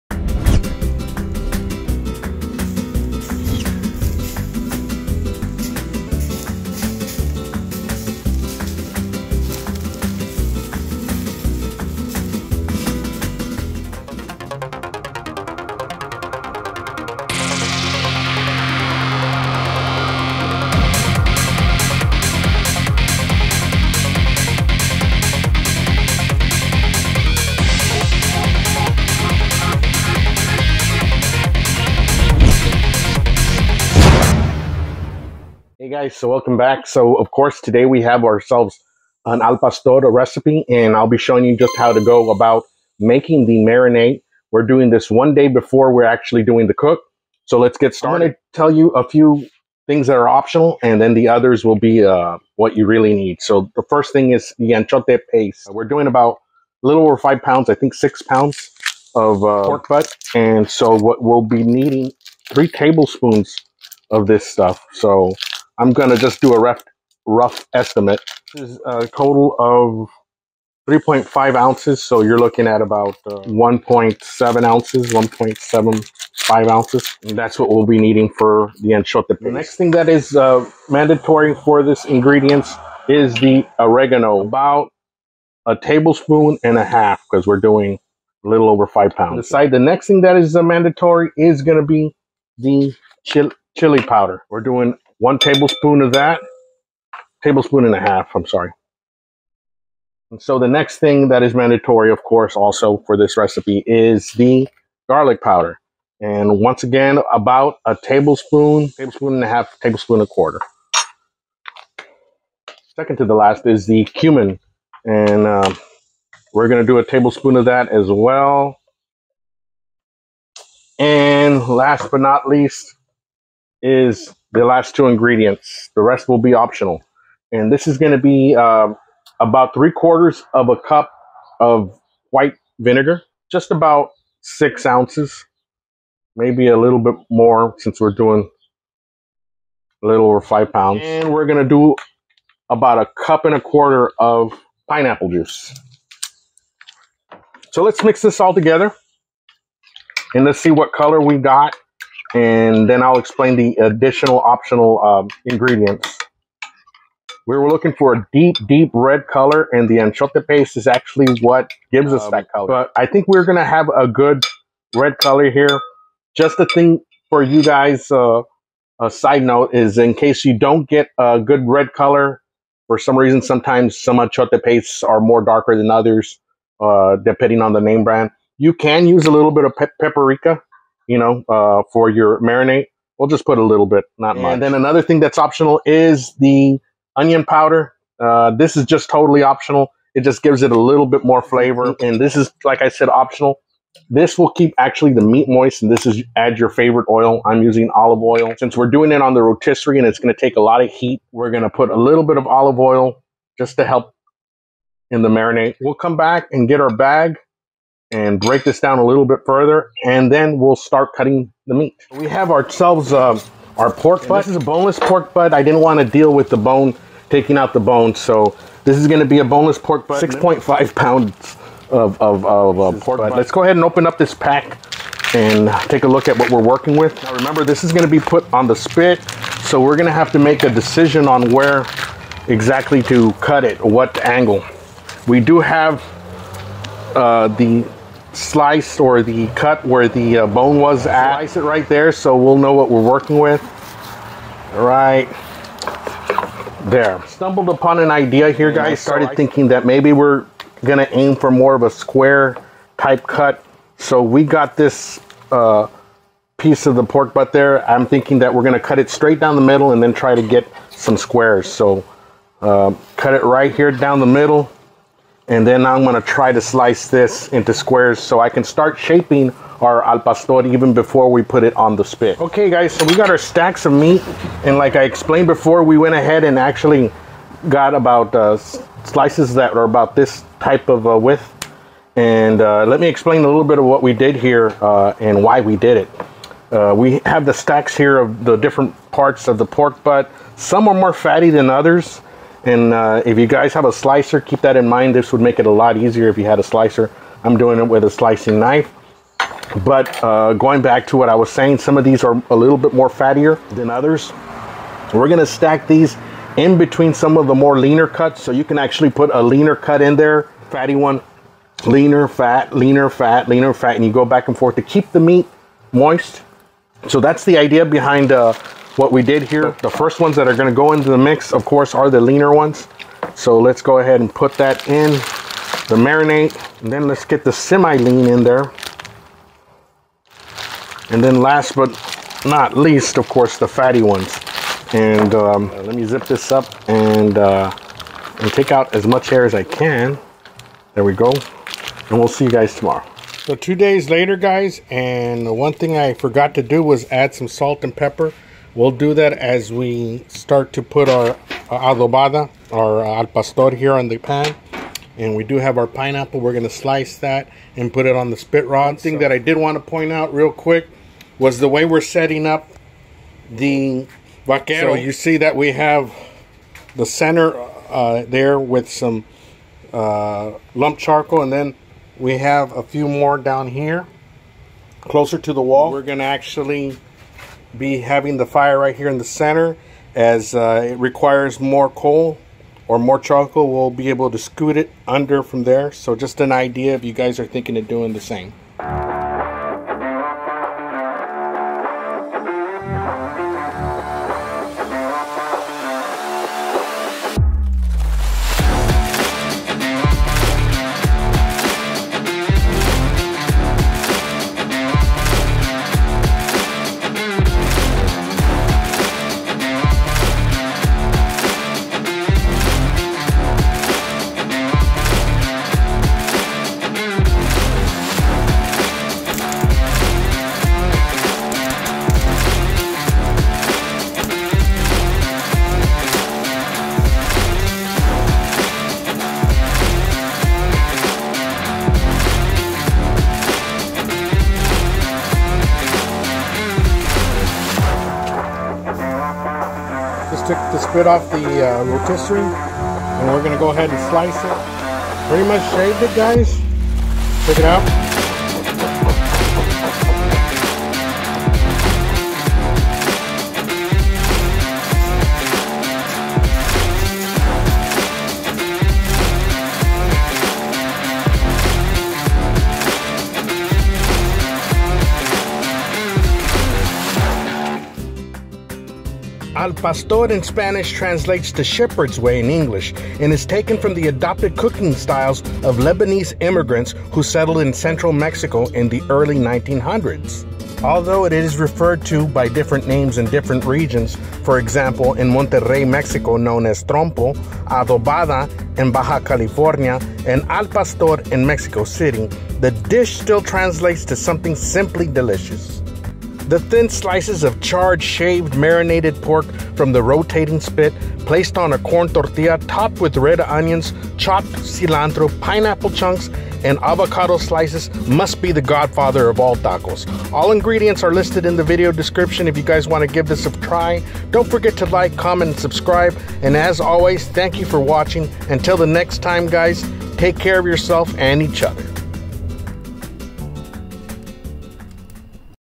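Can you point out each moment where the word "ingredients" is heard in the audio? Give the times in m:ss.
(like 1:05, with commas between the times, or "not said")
1:22, 2:05, 2:35, 8:30.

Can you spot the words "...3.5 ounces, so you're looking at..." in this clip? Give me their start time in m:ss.
1:10.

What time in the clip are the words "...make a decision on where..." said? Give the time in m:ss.
3:50.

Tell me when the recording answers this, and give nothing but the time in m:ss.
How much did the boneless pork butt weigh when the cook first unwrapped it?
3:40.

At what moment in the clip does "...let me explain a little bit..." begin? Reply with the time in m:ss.
4:42.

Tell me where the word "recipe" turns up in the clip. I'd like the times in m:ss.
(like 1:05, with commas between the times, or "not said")
0:40, 1:43.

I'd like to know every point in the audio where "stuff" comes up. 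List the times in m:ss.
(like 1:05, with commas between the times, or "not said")
1:04.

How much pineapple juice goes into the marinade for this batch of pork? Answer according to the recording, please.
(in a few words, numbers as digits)
a cup and a quarter.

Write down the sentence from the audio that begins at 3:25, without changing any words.
We'll come back and get our bag and break this down a little bit further, and then we'll start cutting the meat.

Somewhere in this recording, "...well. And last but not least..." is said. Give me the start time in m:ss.
1:58.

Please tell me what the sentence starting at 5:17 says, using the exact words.
So that's the idea behind uh, what we did here.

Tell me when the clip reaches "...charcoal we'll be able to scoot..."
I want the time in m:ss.
6:23.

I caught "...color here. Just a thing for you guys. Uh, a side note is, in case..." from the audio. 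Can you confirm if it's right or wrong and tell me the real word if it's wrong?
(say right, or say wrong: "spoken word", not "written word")
right.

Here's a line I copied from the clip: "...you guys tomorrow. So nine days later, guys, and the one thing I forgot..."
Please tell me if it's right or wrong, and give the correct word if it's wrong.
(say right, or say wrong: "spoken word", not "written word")
wrong: "two", not "nine".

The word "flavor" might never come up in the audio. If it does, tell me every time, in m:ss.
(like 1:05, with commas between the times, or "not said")
3:11.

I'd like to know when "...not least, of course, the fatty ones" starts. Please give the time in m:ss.
5:32.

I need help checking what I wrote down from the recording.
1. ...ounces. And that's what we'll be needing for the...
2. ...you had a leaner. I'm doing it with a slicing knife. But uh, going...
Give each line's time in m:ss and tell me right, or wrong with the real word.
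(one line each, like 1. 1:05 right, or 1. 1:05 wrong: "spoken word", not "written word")
1. 1:16 right
2. 4:56 wrong: "slicer", not "leaner".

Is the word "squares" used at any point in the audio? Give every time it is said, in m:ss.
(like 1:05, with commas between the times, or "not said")
4:11, 4:21, 4:27.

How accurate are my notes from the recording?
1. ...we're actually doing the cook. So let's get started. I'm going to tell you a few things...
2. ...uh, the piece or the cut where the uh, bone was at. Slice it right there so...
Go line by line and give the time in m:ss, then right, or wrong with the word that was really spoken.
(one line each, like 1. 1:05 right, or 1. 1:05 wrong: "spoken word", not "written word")
1. 0:45 right
2. 3:57 wrong: "slice", not "piece".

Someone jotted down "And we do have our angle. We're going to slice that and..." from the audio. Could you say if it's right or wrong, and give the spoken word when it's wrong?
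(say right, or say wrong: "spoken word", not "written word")
wrong: "pineapple", not "angle".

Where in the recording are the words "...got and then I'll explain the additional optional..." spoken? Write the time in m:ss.
2:31.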